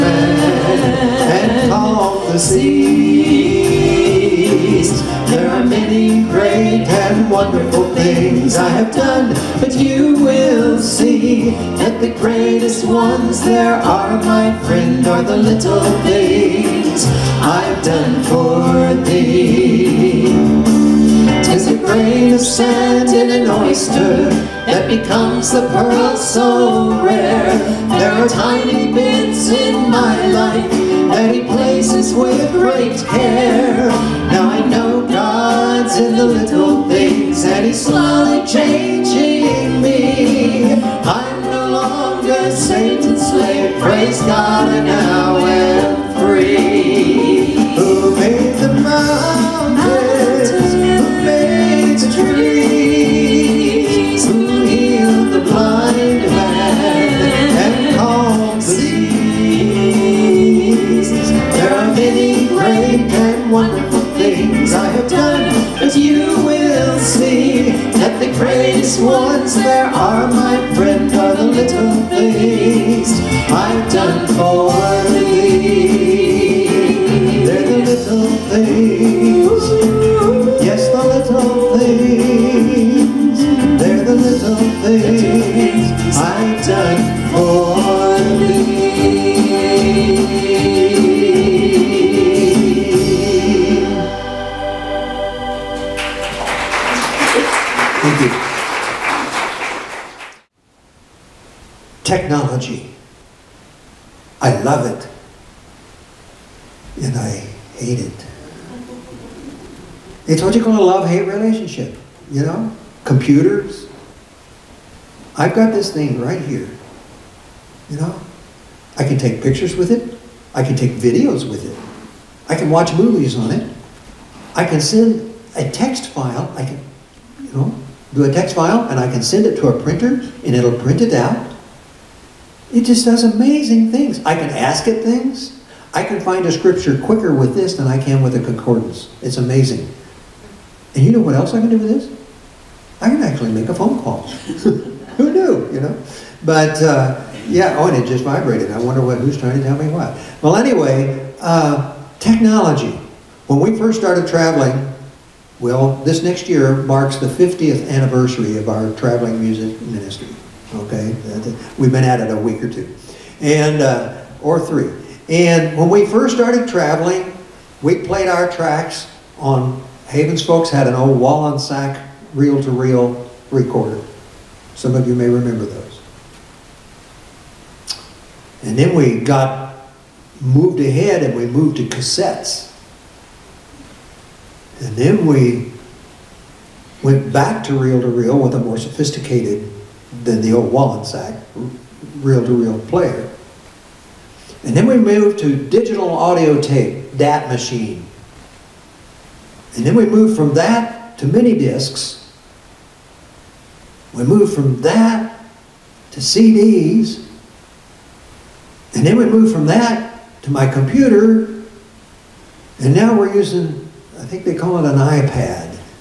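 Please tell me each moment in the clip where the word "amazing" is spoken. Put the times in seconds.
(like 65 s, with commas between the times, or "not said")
133 s, 139 s.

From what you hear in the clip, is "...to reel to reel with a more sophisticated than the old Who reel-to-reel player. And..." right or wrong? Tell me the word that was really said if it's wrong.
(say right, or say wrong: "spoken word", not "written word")
wrong: "Wollensak", not "Who".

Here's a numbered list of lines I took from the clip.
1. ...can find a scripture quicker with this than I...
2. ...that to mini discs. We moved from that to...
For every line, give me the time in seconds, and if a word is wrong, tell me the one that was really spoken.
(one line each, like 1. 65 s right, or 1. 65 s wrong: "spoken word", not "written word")
1. 136 s right
2. 200 s right.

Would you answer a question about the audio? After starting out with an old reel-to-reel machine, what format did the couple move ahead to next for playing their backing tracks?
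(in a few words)
cassettes.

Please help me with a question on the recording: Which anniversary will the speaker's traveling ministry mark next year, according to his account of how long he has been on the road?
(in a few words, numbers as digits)
50th.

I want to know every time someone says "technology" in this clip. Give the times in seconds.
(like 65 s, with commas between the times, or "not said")
102 s, 152 s.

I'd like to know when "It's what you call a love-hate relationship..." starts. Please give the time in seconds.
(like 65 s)
110 s.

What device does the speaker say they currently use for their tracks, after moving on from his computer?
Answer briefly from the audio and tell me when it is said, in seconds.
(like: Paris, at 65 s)
iPad, at 214 s.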